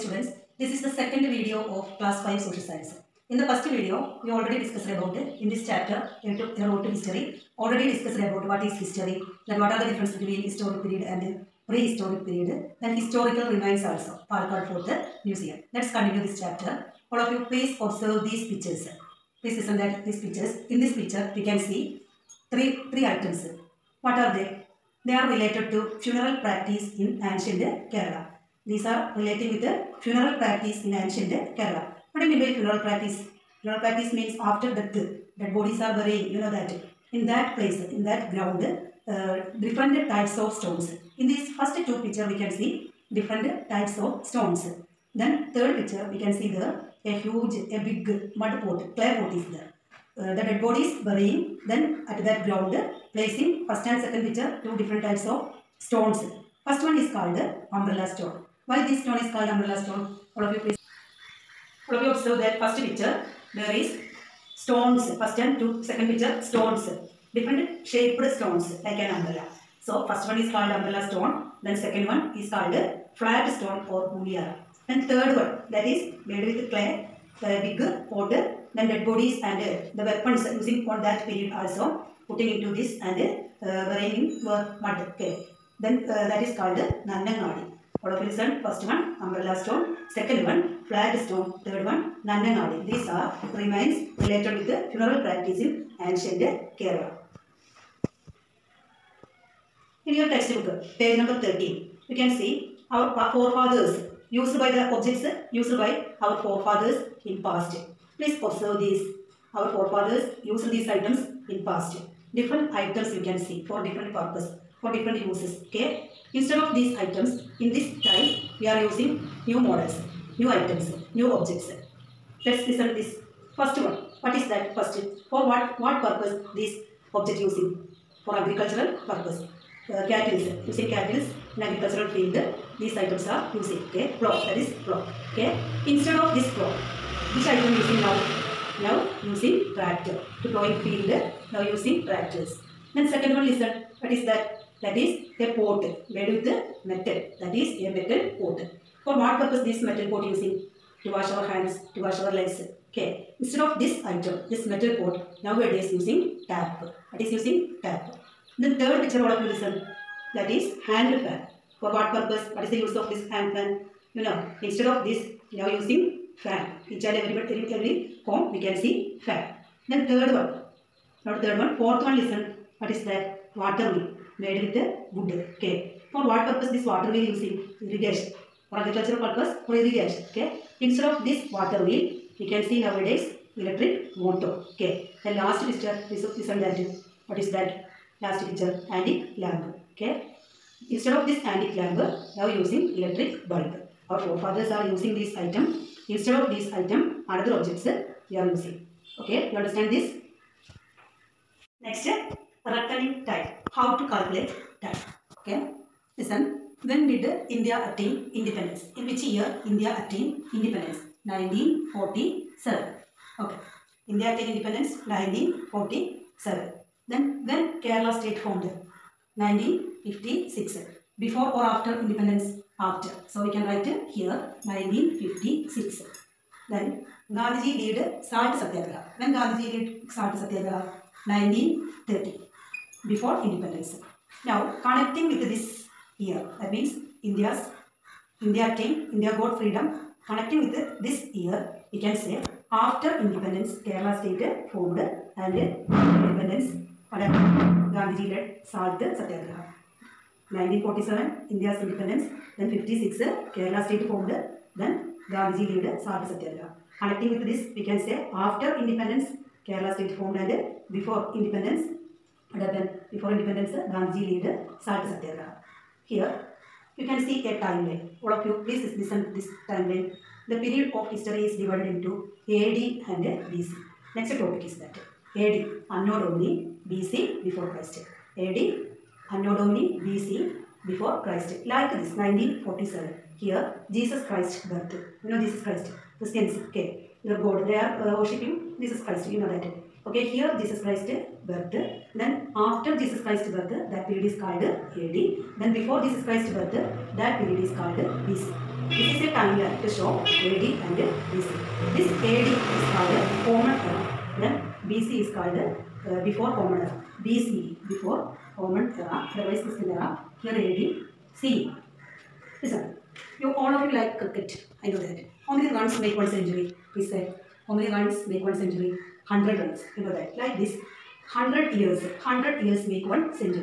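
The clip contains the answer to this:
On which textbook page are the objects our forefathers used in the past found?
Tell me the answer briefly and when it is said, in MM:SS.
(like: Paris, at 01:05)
13, at 01:40.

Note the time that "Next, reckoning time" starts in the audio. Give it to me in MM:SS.
03:21.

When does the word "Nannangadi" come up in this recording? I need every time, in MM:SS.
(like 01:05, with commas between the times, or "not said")
01:27, 01:32.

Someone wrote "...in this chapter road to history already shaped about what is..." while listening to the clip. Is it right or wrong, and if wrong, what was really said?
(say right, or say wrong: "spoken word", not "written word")
wrong: "discussed", not "shaped".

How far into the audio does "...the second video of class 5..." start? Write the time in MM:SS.
00:00.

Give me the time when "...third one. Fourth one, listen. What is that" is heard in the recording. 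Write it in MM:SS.
02:51.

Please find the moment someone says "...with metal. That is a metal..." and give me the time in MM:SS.
02:26.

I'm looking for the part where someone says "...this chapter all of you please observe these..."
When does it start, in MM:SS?
00:16.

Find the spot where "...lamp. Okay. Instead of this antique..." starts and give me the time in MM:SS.
03:09.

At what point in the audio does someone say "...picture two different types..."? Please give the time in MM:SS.
00:54.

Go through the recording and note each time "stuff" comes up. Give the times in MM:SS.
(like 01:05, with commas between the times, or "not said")
not said.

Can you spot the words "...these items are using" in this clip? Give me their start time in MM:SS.
02:12.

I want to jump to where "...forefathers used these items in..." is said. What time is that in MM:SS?
01:49.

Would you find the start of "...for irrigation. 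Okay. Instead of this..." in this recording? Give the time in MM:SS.
02:59.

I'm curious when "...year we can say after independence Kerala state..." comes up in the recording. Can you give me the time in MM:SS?
04:01.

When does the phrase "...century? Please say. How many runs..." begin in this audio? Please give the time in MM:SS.
05:16.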